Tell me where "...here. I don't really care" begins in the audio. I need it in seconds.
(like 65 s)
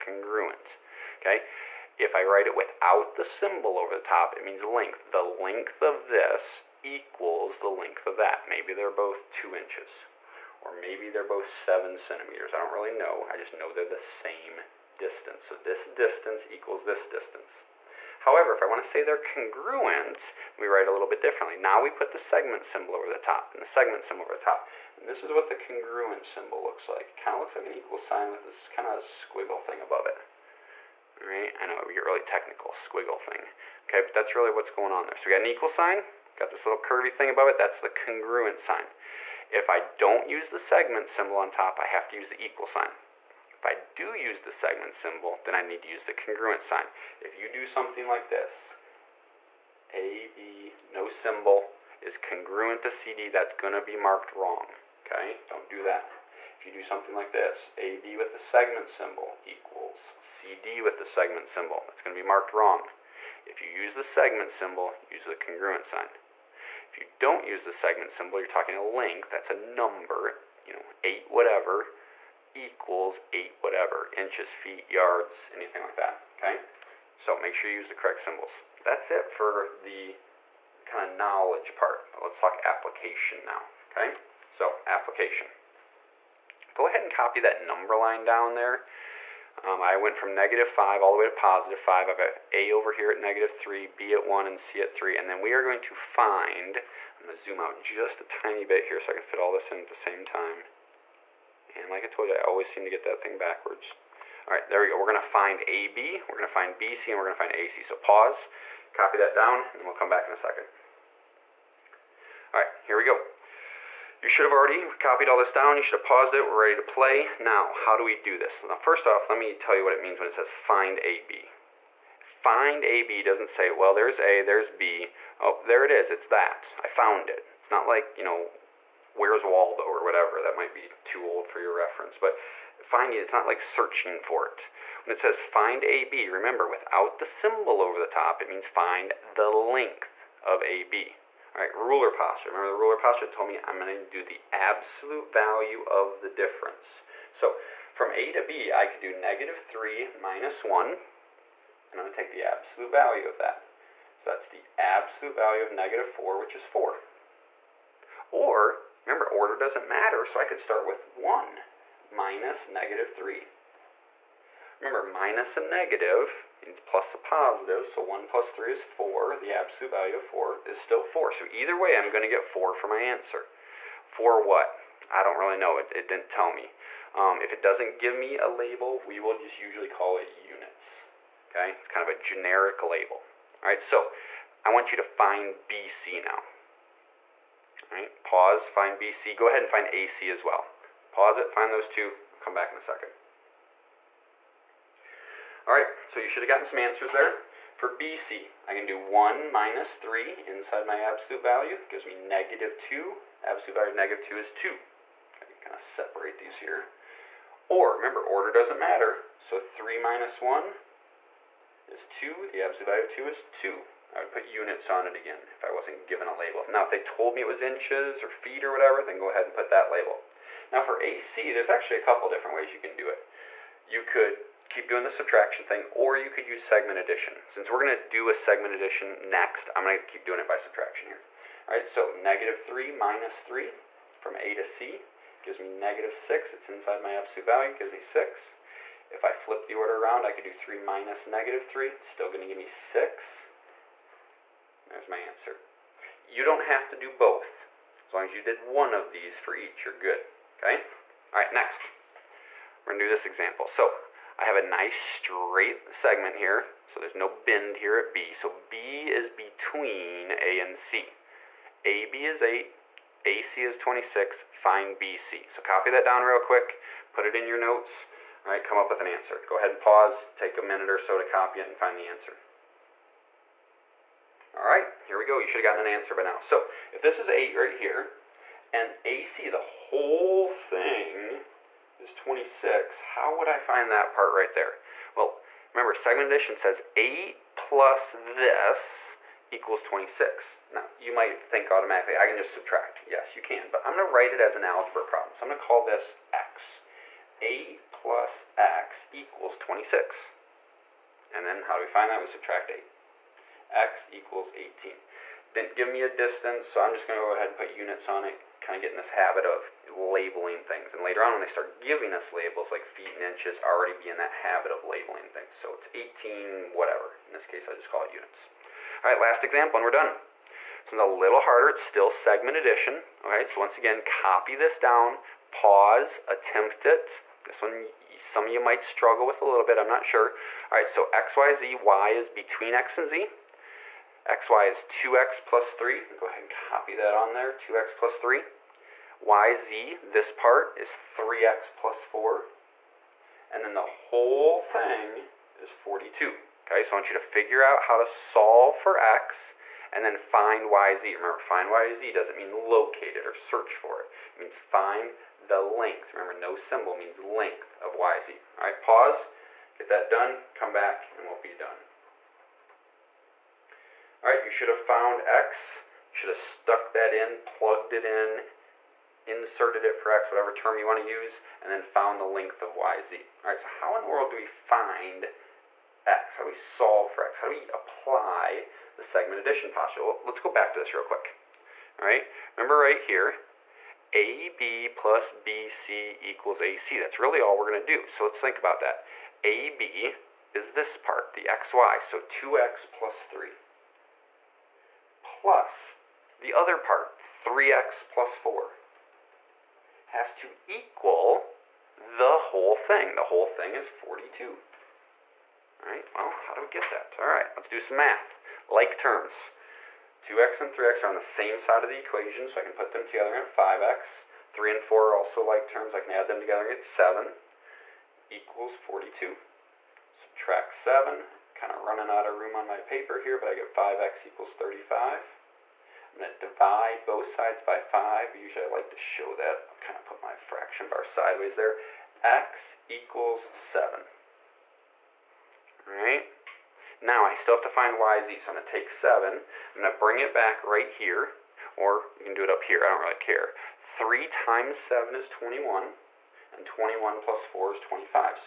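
442 s.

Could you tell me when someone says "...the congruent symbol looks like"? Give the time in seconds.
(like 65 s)
25 s.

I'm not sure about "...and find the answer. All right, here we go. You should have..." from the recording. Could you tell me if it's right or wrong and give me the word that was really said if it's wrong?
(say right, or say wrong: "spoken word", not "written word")
right.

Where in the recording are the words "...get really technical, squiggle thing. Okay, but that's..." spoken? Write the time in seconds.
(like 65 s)
31 s.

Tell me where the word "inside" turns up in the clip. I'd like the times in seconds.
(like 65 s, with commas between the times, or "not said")
200 s, 236 s.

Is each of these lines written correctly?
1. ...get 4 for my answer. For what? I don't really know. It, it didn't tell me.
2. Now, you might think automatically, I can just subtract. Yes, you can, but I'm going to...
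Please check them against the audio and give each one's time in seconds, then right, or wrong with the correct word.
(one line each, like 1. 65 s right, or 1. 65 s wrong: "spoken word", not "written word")
1. 172 s right
2. 290 s right.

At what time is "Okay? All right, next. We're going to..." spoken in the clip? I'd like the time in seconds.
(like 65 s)
250 s.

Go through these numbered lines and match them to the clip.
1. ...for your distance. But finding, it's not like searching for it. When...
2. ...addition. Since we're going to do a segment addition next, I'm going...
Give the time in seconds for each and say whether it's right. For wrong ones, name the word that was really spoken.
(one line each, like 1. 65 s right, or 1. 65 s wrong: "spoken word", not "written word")
1. 131 s wrong: "reference", not "distance"
2. 226 s right.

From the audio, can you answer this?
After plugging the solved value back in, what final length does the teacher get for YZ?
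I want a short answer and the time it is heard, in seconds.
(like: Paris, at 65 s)
25, at 447 s.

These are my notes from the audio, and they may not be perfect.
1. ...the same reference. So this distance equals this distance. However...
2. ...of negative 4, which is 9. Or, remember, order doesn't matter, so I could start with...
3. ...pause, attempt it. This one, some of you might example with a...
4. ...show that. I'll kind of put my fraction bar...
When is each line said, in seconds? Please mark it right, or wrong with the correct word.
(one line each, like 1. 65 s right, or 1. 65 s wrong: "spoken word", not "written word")
1. 13 s wrong: "distance", not "reference"
2. 155 s wrong: "4", not "9"
3. 325 s wrong: "struggle", not "example"
4. 428 s right.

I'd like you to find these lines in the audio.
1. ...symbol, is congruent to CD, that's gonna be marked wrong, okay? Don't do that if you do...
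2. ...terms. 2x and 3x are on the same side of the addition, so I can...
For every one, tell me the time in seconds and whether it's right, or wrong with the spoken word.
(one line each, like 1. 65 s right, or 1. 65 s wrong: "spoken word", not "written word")
1. 51 s right
2. 408 s wrong: "equation", not "addition".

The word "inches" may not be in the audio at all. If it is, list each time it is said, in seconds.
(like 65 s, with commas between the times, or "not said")
9 s, 74 s, 217 s, 313 s.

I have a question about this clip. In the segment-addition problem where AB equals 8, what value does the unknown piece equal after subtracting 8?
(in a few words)
18.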